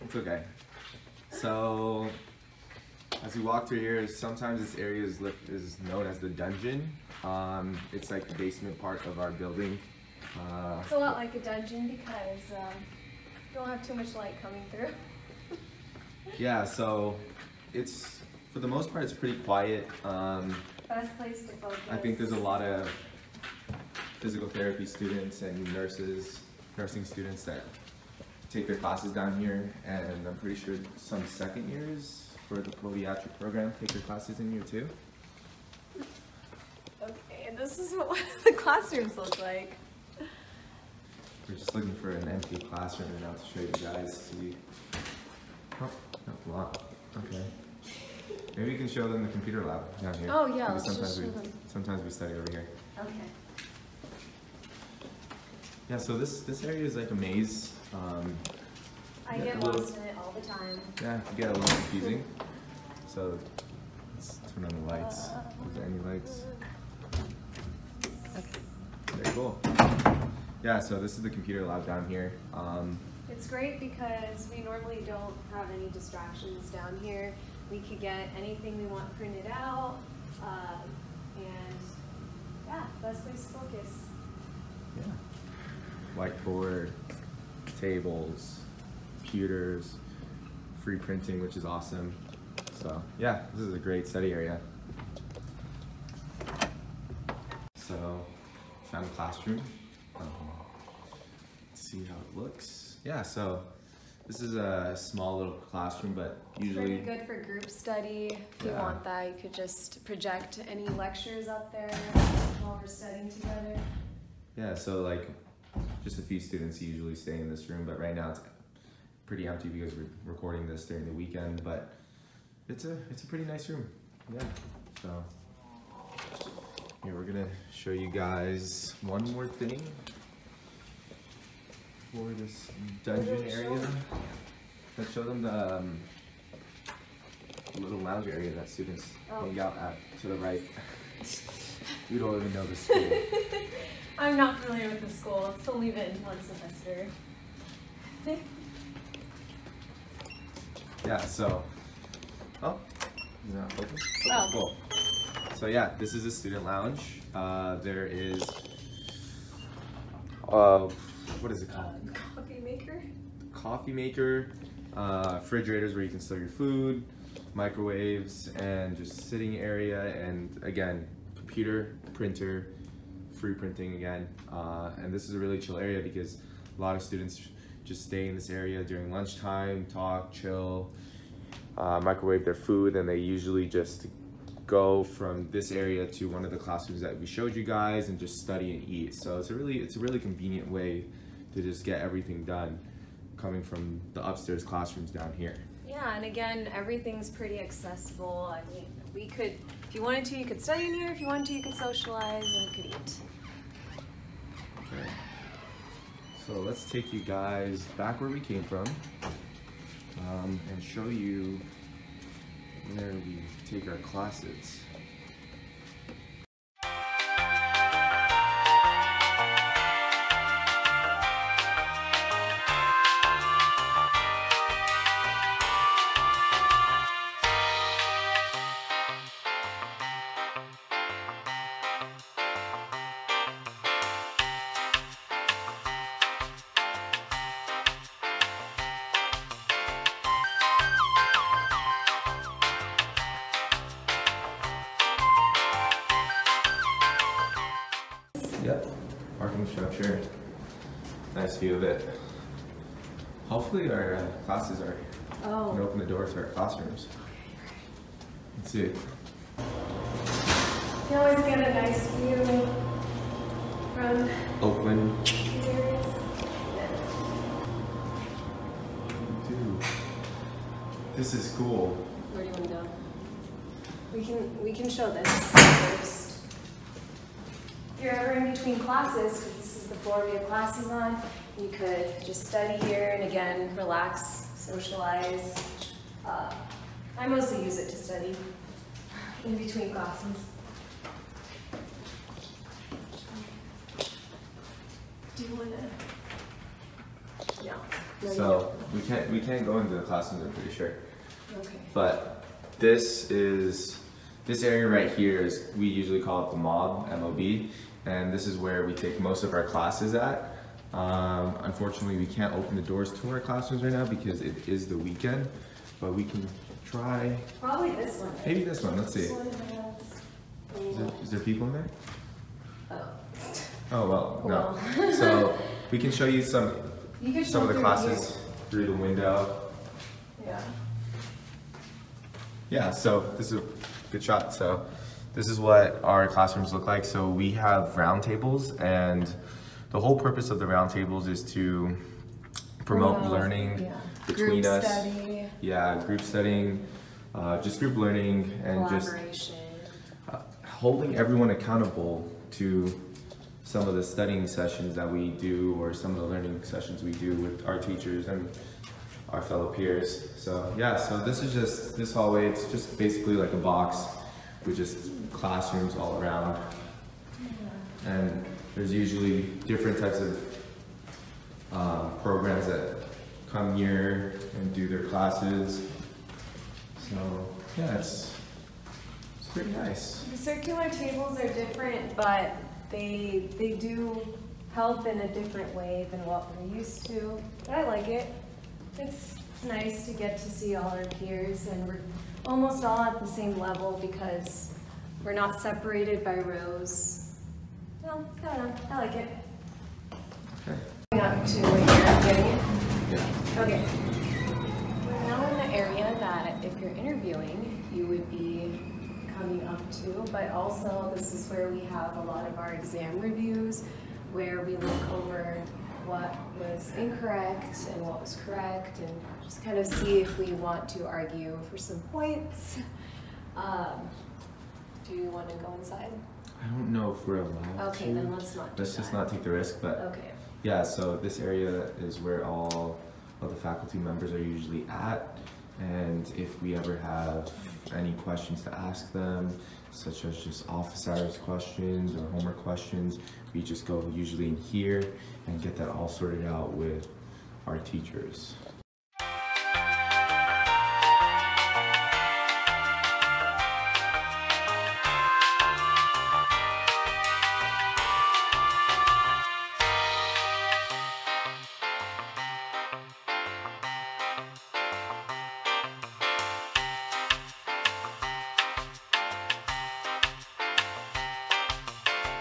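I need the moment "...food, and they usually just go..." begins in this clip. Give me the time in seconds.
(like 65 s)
182 s.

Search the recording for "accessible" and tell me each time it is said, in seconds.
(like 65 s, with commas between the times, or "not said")
197 s.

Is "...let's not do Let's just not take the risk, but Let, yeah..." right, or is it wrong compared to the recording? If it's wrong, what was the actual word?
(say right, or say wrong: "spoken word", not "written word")
wrong: "Okay", not "Let".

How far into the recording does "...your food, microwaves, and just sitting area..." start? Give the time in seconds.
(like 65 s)
166 s.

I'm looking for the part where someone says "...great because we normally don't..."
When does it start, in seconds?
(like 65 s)
73 s.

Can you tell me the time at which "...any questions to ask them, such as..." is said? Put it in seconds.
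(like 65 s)
437 s.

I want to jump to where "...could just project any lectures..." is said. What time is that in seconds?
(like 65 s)
109 s.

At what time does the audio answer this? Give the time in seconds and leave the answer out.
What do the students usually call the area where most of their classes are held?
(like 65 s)
306 s.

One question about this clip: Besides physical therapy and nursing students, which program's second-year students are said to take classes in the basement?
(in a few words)
podiatric program.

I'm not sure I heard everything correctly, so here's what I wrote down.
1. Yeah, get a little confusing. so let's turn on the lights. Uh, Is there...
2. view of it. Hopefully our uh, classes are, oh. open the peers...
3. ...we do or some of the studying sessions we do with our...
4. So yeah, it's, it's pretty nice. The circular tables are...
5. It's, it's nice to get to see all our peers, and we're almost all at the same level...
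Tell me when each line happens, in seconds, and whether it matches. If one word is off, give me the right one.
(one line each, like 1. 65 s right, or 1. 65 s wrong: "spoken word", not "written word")
1. 60 s right
2. 251 s wrong: "doors", not "peers"
3. 355 s wrong: "learning", not "studying"
4. 377 s right
5. 388 s right.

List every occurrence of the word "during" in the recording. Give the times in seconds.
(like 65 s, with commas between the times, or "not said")
120 s, 178 s.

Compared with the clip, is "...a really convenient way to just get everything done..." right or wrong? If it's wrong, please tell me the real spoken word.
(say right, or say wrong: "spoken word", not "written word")
right.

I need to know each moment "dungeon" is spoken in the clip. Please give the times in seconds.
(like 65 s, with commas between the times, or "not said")
6 s, 11 s, 133 s.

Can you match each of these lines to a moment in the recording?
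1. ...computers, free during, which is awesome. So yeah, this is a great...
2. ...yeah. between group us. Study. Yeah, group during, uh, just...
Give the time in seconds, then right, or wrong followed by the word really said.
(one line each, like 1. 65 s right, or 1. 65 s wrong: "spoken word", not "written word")
1. 89 s wrong: "printing", not "during"
2. 343 s wrong: "studying", not "during".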